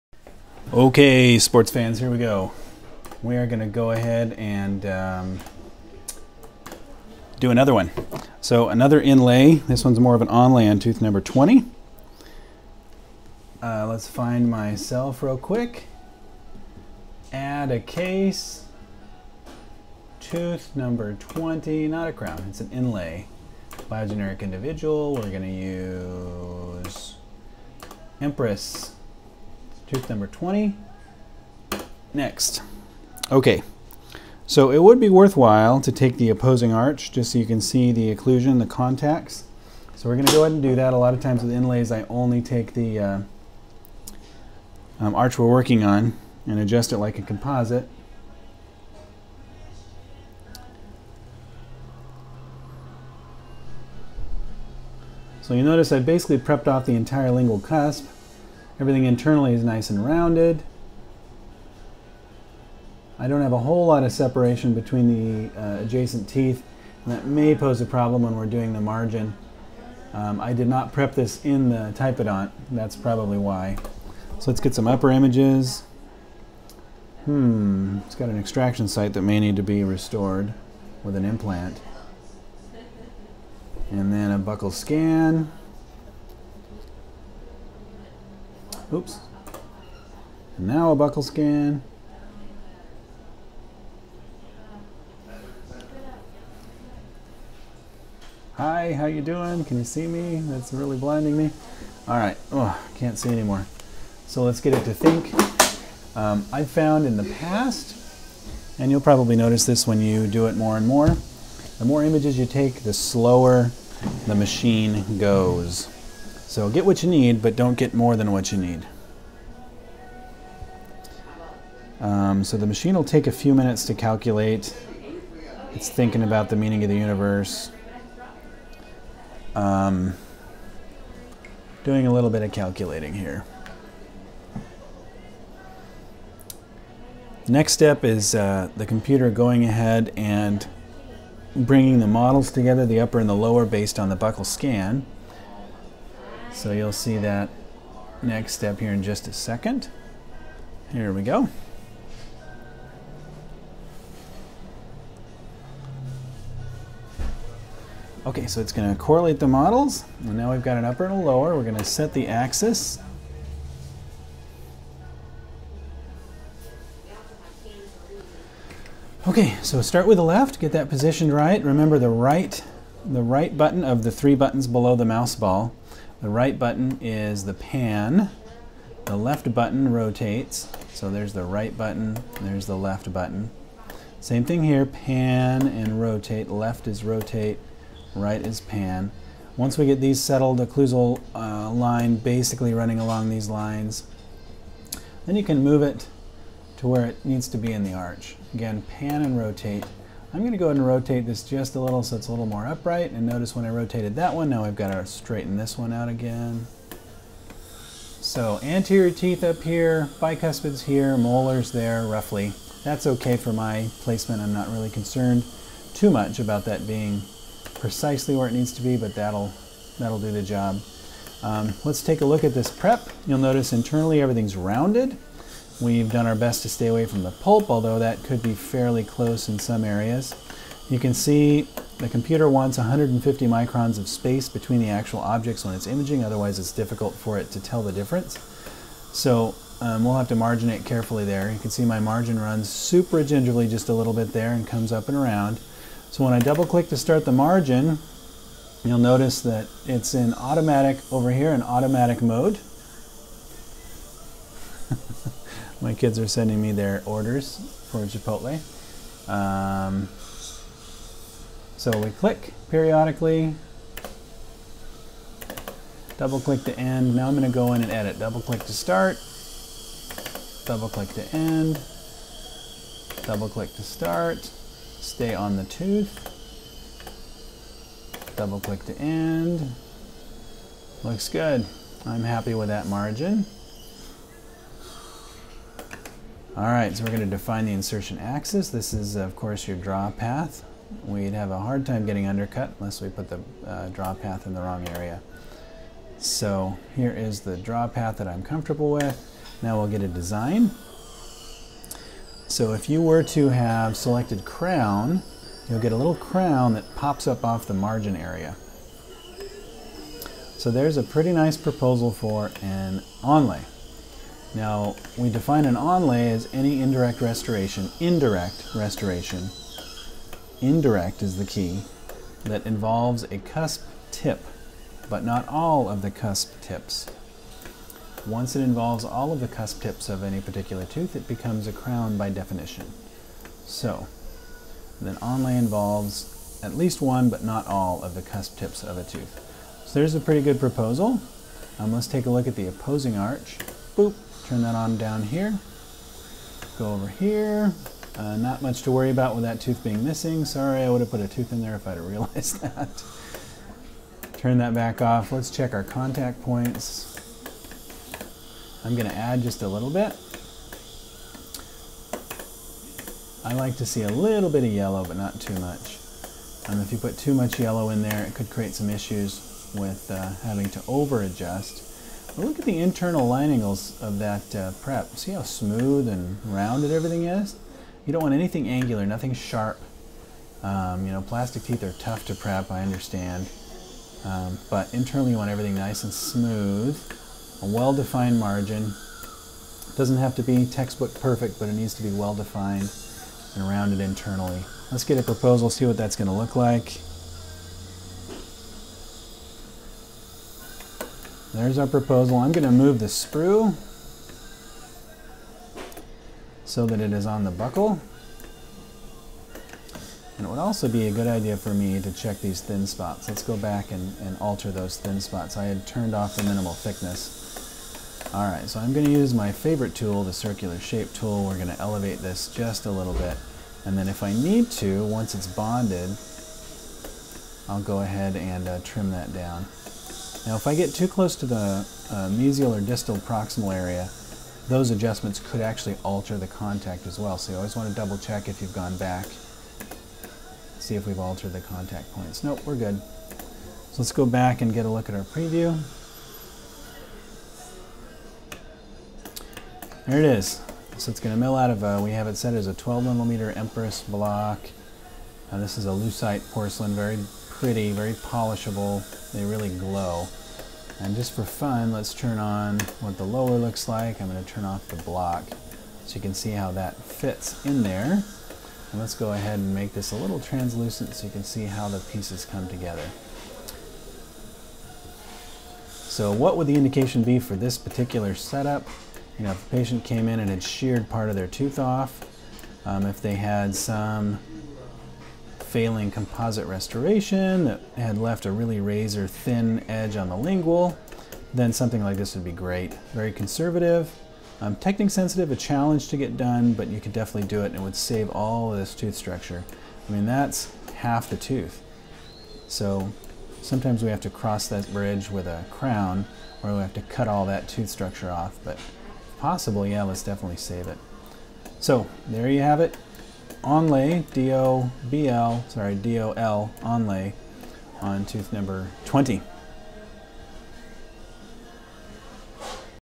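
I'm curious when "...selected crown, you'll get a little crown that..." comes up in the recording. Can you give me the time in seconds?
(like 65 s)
303 s.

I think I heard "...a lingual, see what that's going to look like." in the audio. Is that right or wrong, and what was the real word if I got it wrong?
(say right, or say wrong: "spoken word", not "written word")
wrong: "proposal", not "lingual".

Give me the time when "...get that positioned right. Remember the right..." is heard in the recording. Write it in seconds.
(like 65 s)
170 s.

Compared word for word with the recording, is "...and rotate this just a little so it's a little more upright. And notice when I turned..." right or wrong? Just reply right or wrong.
wrong.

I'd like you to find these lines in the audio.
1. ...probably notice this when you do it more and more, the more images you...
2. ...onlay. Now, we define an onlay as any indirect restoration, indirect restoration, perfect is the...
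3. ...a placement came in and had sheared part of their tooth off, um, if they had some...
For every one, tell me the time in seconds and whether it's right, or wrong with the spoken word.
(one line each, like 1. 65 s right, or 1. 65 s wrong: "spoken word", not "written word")
1. 108 s right
2. 313 s wrong: "indirect", not "perfect"
3. 479 s wrong: "patient", not "placement".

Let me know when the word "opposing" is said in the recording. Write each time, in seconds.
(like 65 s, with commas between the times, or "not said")
36 s, 342 s.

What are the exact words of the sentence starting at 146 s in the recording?
So you'll see that next step here in just a second.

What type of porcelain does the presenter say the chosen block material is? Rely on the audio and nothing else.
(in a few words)
leucite.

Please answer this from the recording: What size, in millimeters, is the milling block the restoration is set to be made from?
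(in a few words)
12.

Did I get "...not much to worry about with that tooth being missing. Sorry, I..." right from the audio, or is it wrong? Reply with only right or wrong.
right.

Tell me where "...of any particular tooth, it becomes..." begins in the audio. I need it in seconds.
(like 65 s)
330 s.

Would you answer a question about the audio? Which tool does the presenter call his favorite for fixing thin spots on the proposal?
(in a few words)
circular shape tool.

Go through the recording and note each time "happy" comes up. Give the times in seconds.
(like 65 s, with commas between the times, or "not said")
282 s.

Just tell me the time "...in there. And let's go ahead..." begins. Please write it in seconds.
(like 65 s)
467 s.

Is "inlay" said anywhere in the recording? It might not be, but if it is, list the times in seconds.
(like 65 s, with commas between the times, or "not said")
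9 s, 22 s, 41 s.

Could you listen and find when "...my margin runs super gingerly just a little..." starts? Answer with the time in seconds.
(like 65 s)
241 s.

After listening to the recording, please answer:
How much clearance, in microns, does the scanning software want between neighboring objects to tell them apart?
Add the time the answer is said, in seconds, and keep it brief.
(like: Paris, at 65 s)
150, at 232 s.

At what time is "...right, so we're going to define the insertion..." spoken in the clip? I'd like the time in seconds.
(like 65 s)
286 s.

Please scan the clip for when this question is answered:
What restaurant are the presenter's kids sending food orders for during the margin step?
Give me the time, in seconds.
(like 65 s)
258 s.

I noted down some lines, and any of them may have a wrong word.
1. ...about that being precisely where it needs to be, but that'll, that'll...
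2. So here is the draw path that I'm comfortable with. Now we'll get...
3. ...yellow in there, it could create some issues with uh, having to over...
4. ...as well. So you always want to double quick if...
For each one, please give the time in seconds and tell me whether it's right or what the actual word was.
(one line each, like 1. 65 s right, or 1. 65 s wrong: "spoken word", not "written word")
1. 216 s right
2. 296 s right
3. 367 s right
4. 437 s wrong: "check", not "quick".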